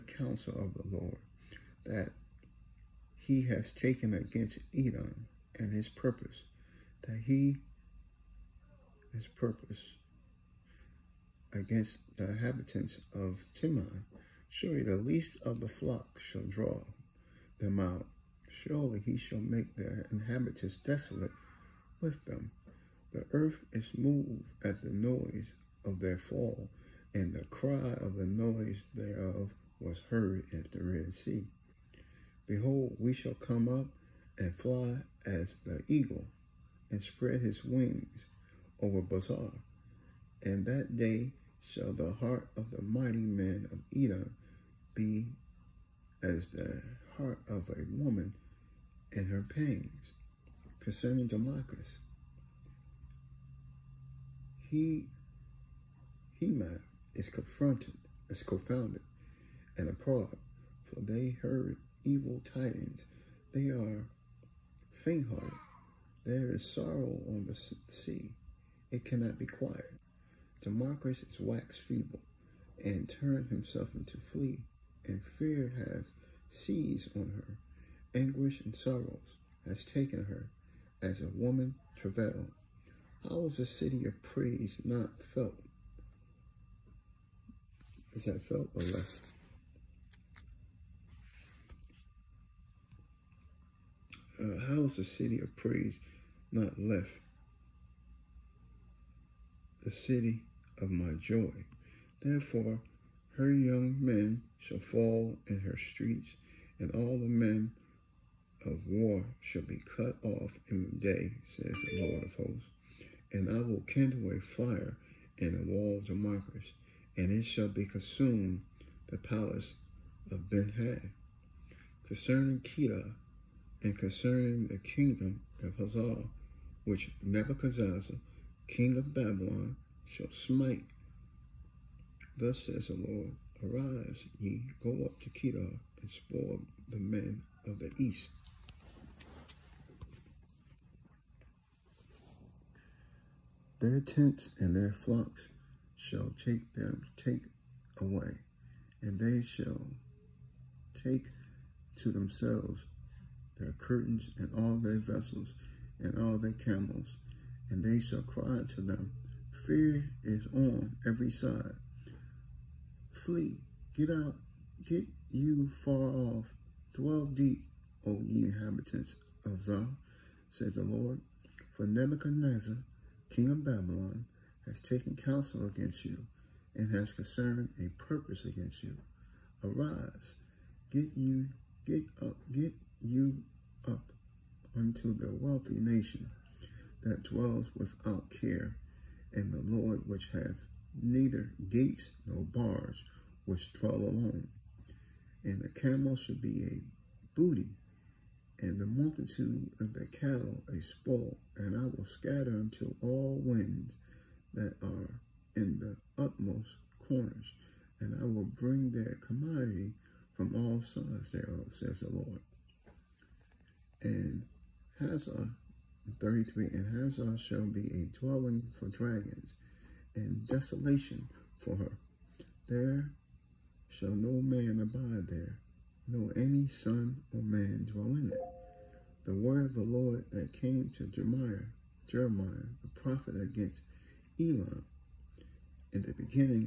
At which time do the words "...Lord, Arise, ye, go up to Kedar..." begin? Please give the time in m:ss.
2:12.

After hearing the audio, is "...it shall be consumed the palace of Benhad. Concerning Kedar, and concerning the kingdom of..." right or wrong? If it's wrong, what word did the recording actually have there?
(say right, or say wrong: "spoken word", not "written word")
right.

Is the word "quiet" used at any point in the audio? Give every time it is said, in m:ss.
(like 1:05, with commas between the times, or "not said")
1:09.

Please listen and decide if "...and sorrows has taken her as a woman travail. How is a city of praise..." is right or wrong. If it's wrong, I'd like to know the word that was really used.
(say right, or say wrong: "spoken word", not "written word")
right.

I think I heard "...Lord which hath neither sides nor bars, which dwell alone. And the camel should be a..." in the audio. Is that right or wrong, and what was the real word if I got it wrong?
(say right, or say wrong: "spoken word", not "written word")
wrong: "gates", not "sides".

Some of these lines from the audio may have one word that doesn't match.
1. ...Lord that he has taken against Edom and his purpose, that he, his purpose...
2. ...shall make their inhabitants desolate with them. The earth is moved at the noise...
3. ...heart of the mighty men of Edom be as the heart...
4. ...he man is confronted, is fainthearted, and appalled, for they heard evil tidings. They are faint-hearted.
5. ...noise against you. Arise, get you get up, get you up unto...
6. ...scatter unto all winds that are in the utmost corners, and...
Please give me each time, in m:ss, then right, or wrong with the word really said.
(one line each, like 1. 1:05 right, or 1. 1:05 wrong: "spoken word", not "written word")
1. 0:00 right
2. 0:19 right
3. 0:42 right
4. 0:56 wrong: "confounded", not "fainthearted"
5. 2:58 wrong: "purpose", not "noise"
6. 3:22 right.